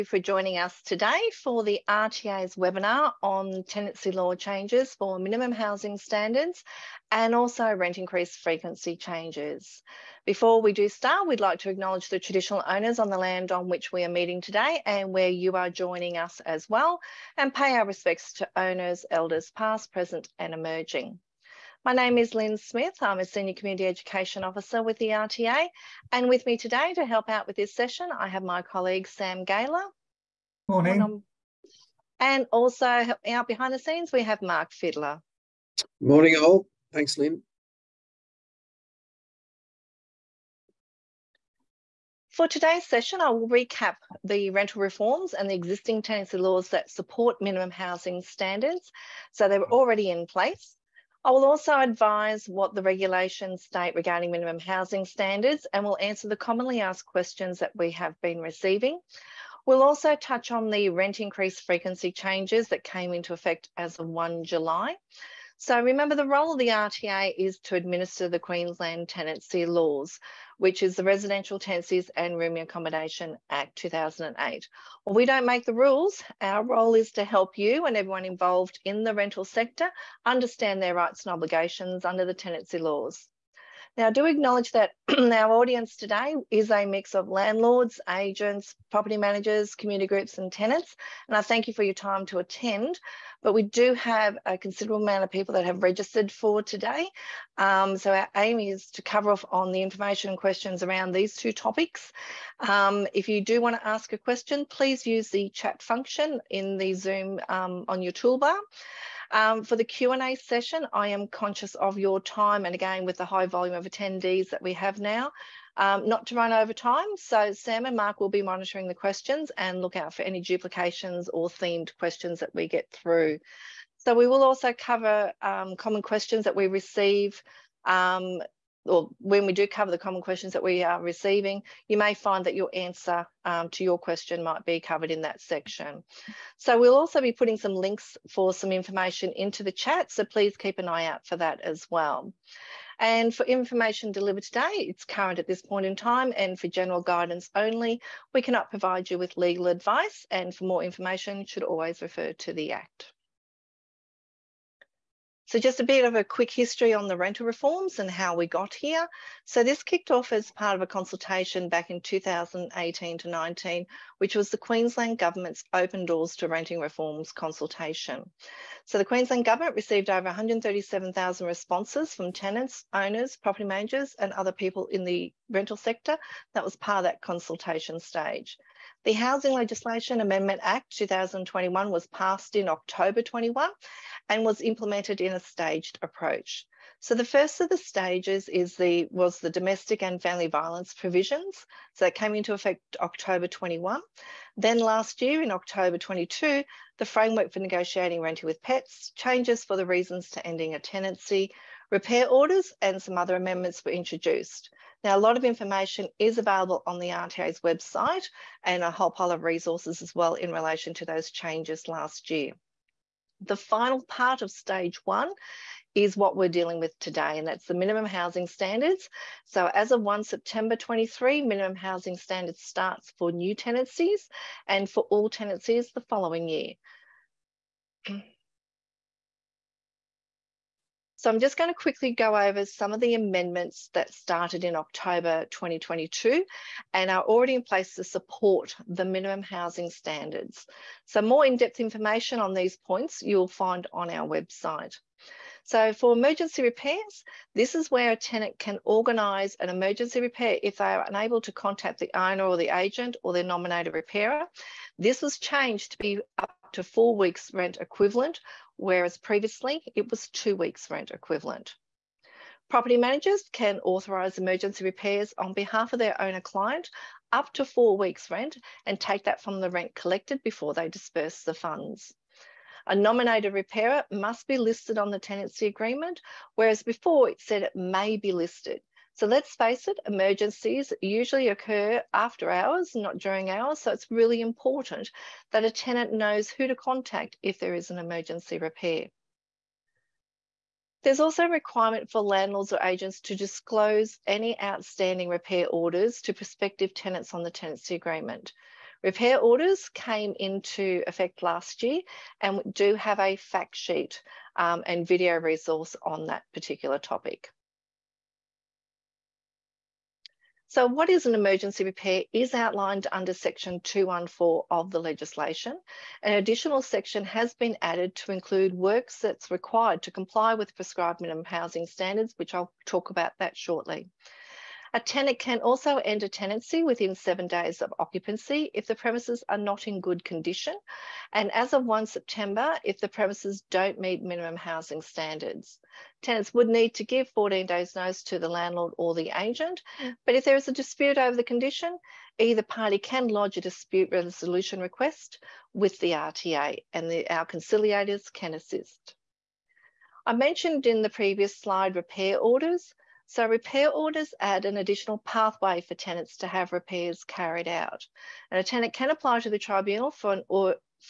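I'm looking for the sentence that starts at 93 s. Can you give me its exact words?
But we do have a considerable amount of people that have registered for today.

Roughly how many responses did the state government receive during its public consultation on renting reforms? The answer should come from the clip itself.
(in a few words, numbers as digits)
137,000.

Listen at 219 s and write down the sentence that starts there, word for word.
So as of 1 September 23, minimum housing standards starts for new tenancies and for all tenancies the following year.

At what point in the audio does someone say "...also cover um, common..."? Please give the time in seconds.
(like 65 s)
124 s.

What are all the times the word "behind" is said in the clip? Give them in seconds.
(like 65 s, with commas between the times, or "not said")
33 s.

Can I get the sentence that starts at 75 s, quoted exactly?
Well, we don't make the rules.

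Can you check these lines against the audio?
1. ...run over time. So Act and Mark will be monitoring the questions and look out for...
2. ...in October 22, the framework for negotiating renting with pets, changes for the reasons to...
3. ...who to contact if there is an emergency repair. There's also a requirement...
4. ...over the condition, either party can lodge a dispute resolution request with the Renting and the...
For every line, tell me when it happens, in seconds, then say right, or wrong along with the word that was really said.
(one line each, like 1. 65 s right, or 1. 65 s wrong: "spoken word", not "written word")
1. 116 s wrong: "Sam", not "Act"
2. 195 s right
3. 286 s right
4. 341 s wrong: "RTA", not "Renting".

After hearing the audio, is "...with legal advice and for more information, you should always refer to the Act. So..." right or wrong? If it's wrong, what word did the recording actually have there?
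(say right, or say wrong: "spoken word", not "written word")
right.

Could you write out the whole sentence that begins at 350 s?
I mentioned in the previous slide repair orders.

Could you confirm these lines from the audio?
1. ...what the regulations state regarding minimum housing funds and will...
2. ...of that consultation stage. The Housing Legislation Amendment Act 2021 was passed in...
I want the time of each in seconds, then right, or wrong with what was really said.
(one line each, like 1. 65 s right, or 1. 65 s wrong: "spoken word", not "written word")
1. 52 s wrong: "standards", not "funds"
2. 176 s right.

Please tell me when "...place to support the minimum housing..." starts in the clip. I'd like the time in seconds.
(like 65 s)
237 s.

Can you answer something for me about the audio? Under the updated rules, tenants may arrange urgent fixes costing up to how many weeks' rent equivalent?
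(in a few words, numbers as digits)
4 weeks.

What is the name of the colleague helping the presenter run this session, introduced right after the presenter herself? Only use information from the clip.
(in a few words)
Sam Gaylor.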